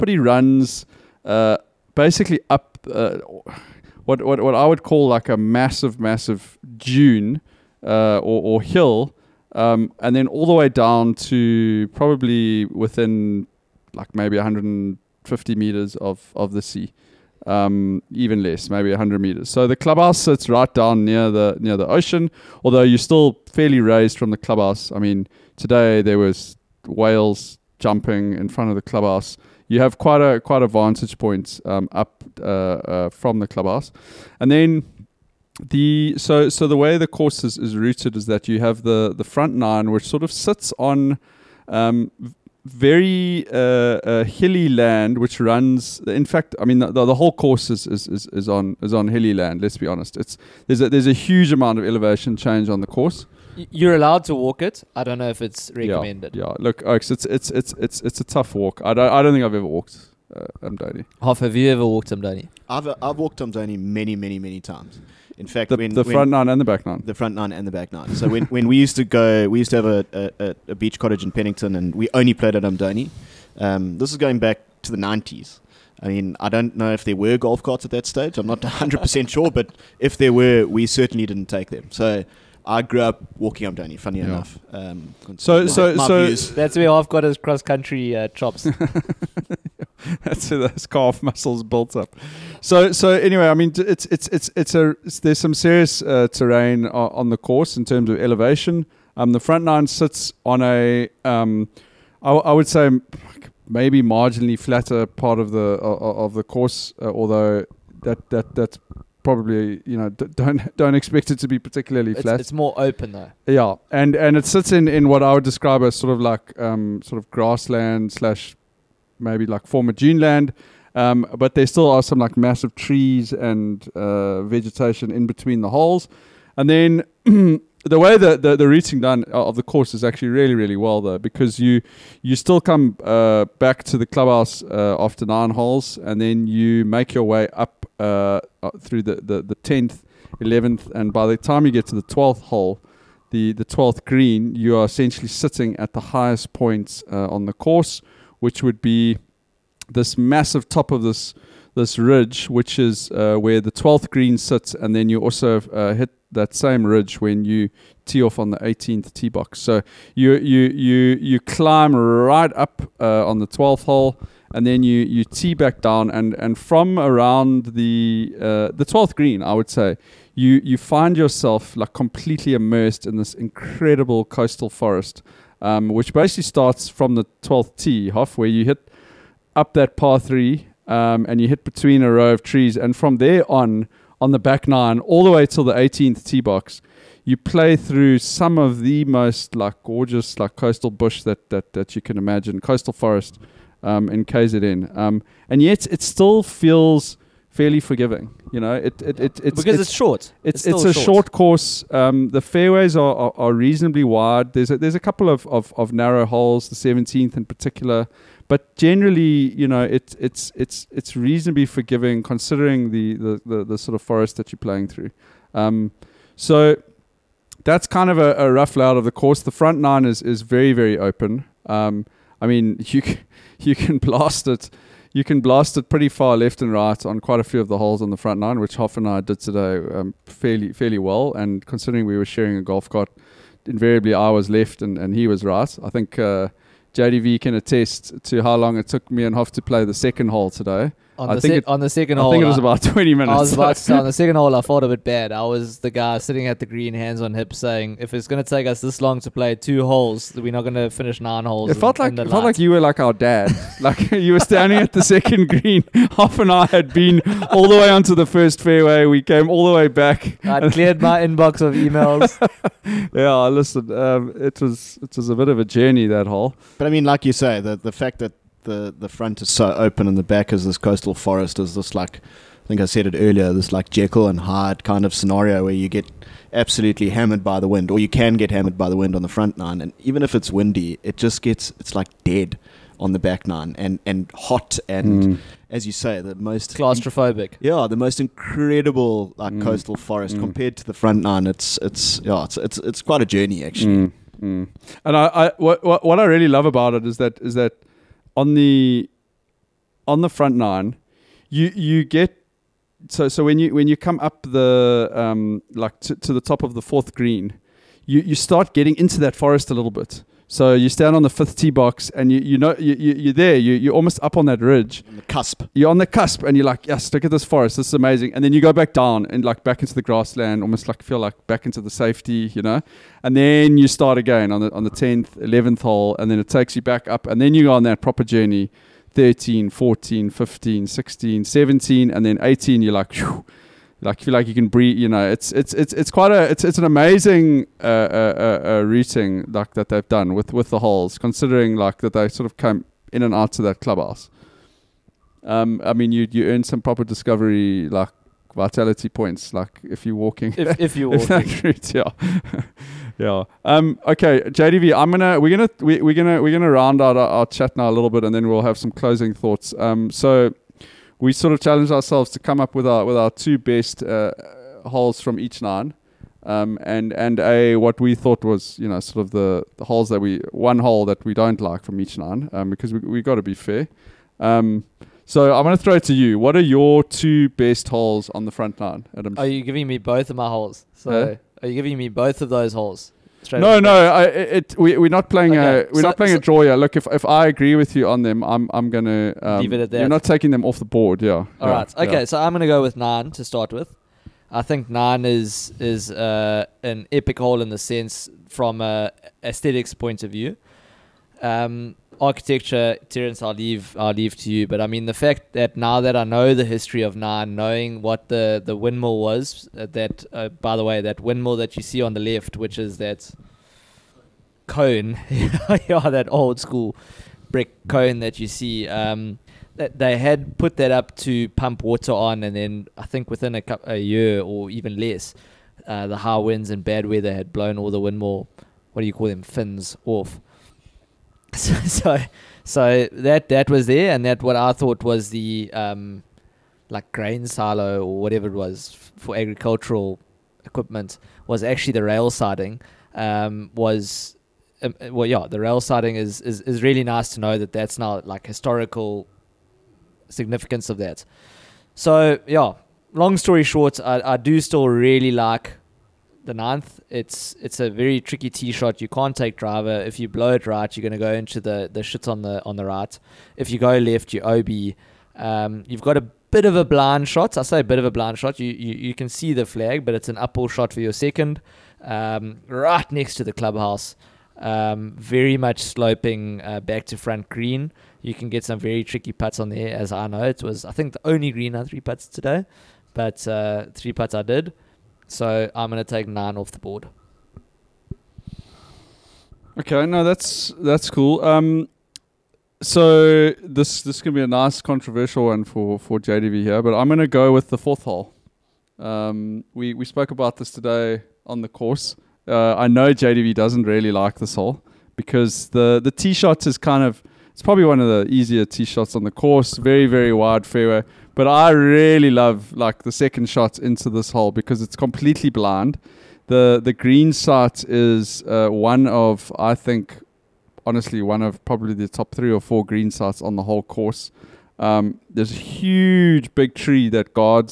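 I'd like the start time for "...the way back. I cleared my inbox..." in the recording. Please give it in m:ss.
4:19.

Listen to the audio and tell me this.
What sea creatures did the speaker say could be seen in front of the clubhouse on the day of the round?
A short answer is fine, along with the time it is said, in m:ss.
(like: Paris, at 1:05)
Whales, at 0:26.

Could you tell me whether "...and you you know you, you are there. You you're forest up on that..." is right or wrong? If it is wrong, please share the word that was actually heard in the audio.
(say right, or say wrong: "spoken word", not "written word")
wrong: "almost", not "forest".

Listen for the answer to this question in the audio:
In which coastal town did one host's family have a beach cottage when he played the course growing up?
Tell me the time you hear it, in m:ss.
1:11.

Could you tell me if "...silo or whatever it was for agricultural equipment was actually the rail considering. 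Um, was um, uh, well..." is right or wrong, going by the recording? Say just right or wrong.
wrong.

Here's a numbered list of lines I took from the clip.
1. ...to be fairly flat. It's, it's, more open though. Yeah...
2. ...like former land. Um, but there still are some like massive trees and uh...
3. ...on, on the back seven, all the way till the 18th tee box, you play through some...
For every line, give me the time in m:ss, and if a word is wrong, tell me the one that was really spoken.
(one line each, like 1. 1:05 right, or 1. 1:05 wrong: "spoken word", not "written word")
1. 1:51 wrong: "particularly", not "fairly"
2. 1:59 right
3. 3:03 wrong: "nine", not "seven".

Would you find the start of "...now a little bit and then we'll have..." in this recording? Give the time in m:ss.
5:57.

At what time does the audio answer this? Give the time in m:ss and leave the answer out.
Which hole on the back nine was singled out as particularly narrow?
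3:26.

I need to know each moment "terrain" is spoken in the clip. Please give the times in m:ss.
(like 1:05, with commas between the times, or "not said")
1:36.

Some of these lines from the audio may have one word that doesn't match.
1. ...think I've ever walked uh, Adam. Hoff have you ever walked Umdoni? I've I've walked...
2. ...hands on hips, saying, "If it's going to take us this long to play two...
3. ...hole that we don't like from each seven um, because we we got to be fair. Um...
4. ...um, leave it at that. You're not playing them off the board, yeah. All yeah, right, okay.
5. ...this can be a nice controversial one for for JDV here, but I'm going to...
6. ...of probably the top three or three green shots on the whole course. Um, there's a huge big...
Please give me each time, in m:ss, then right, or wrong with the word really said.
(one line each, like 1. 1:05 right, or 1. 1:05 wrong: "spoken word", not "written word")
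1. 0:59 wrong: "Umdoni", not "Adam"
2. 4:06 right
3. 6:10 wrong: "nine", not "seven"
4. 6:29 wrong: "taking", not "playing"
5. 8:14 right
6. 8:41 wrong: "four", not "three".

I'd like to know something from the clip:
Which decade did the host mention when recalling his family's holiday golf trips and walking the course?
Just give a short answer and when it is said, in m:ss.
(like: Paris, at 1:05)
The nineties, at 1:14.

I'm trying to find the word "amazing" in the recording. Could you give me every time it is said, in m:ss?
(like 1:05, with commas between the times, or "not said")
5:17, 5:36.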